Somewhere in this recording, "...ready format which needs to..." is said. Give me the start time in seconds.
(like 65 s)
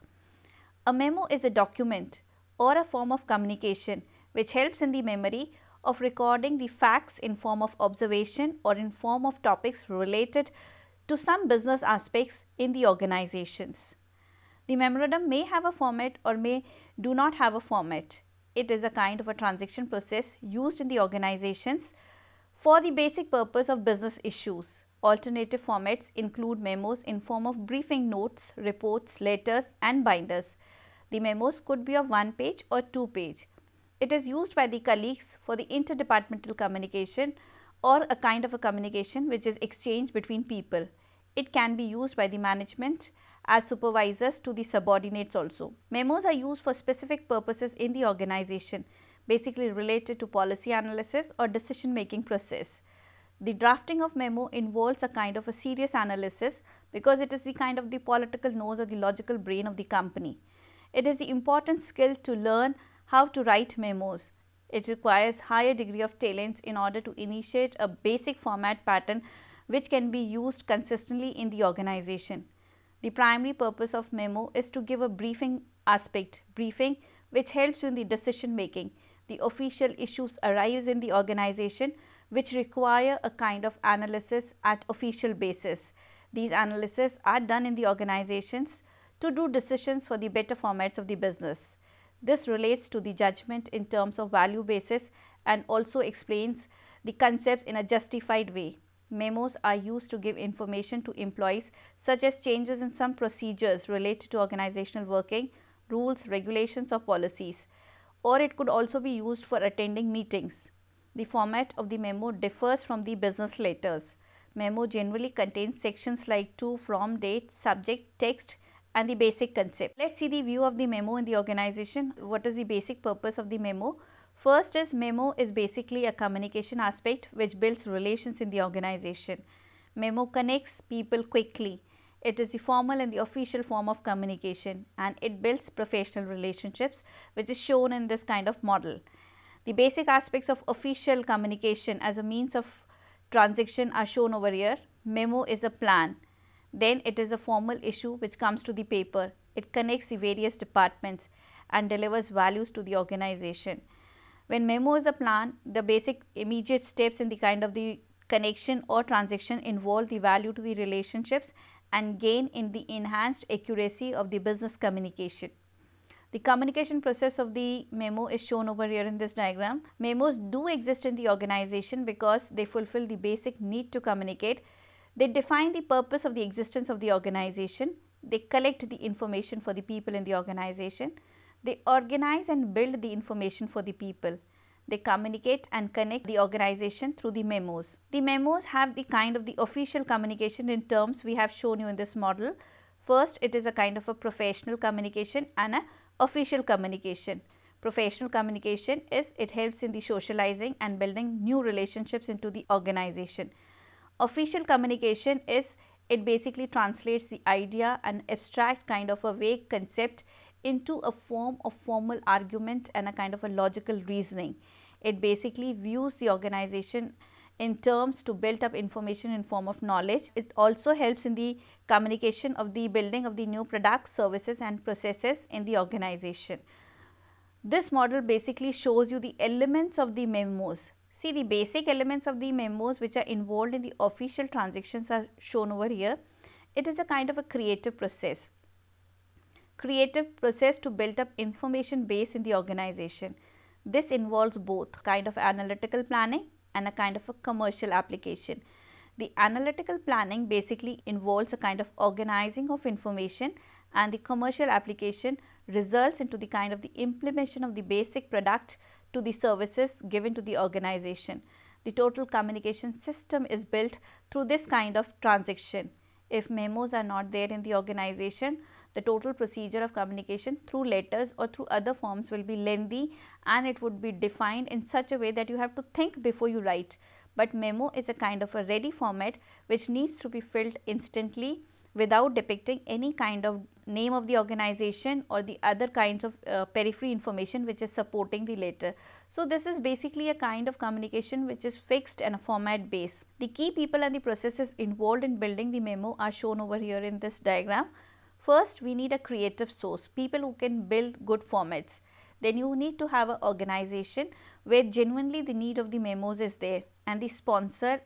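278 s.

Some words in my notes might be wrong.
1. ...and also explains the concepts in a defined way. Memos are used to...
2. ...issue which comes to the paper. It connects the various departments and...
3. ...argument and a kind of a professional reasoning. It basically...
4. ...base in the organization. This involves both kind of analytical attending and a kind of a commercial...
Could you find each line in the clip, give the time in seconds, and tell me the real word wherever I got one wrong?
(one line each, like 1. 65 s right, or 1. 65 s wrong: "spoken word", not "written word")
1. 95 s wrong: "justified", not "defined"
2. 147 s right
3. 212 s wrong: "logical", not "professional"
4. 242 s wrong: "planning", not "attending".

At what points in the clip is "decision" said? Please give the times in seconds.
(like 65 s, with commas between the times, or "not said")
51 s, 78 s, 89 s.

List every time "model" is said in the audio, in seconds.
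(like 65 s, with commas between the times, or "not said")
138 s, 192 s, 227 s.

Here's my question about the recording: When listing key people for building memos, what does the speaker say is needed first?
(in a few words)
A creative source.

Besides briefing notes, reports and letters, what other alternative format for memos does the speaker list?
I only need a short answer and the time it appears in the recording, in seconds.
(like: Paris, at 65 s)
Binders, at 30 s.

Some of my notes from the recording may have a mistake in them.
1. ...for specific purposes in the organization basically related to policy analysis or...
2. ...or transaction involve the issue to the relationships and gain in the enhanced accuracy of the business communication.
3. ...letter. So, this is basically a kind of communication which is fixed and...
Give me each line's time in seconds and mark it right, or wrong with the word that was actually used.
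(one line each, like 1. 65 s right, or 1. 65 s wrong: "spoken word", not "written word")
1. 46 s right
2. 158 s wrong: "value", not "issue"
3. 288 s right.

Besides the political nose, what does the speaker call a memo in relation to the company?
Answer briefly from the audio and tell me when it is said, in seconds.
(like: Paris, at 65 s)
The logical brain, at 58 s.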